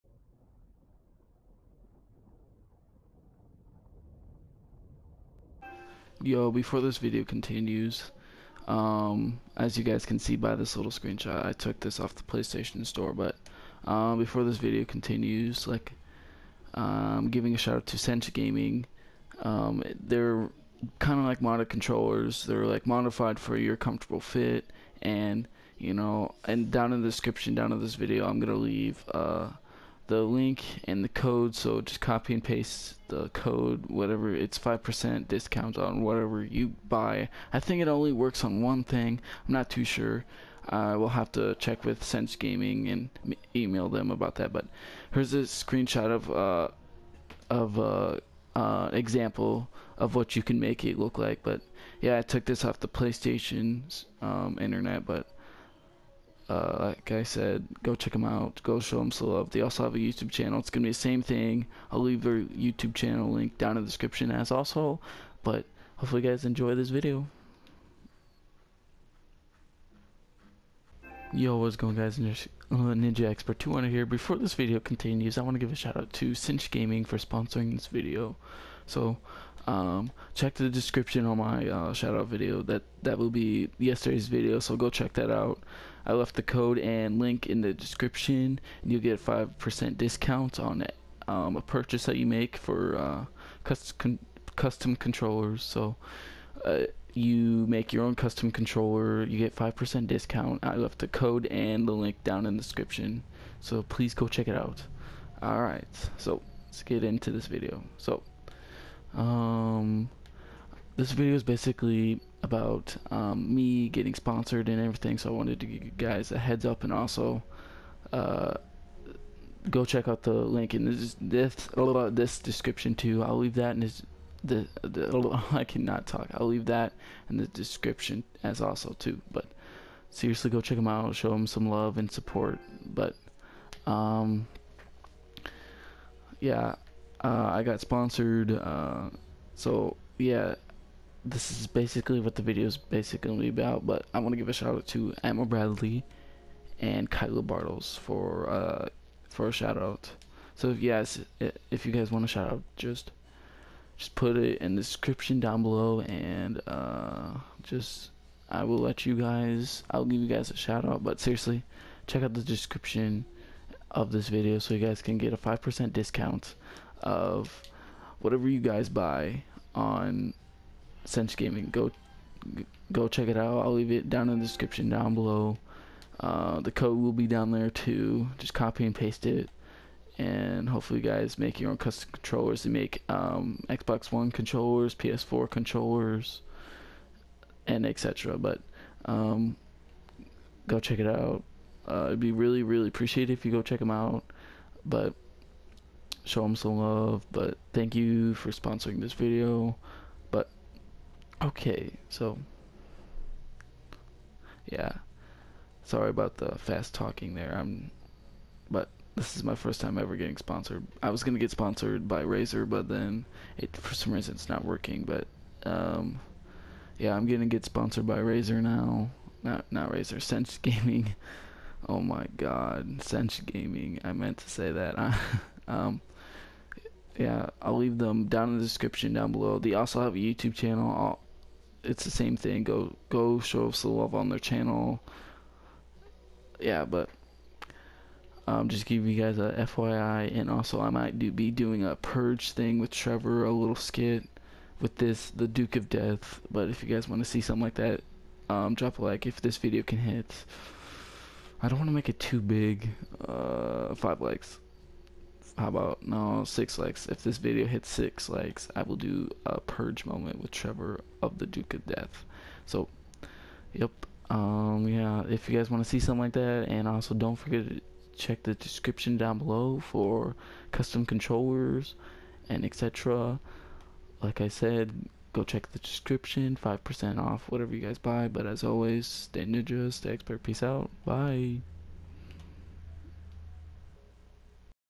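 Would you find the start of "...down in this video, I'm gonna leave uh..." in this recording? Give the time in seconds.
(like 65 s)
27 s.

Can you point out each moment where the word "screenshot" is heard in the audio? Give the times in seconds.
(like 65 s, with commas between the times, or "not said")
10 s, 45 s.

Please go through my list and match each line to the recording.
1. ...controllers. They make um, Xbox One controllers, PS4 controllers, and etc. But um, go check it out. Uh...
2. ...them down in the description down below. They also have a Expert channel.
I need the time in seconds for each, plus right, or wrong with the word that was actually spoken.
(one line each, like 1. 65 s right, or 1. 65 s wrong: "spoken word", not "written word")
1. 182 s right
2. 227 s wrong: "YouTube", not "Expert".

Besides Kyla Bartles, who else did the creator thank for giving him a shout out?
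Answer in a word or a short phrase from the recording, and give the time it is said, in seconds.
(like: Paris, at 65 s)
Admiral Bradley, at 145 s.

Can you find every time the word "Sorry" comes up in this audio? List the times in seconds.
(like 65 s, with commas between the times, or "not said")
205 s.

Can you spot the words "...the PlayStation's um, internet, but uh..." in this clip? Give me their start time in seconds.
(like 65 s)
52 s.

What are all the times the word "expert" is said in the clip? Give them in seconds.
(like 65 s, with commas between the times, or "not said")
73 s, 280 s.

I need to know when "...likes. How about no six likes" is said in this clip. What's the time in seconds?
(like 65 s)
254 s.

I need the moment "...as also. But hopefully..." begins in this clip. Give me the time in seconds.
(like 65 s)
64 s.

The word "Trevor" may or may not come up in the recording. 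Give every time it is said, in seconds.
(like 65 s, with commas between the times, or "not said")
242 s, 260 s.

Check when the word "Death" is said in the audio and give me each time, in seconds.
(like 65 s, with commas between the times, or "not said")
245 s, 261 s.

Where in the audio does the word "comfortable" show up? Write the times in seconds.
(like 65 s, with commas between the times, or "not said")
23 s.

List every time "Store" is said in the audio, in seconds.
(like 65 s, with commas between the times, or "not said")
12 s.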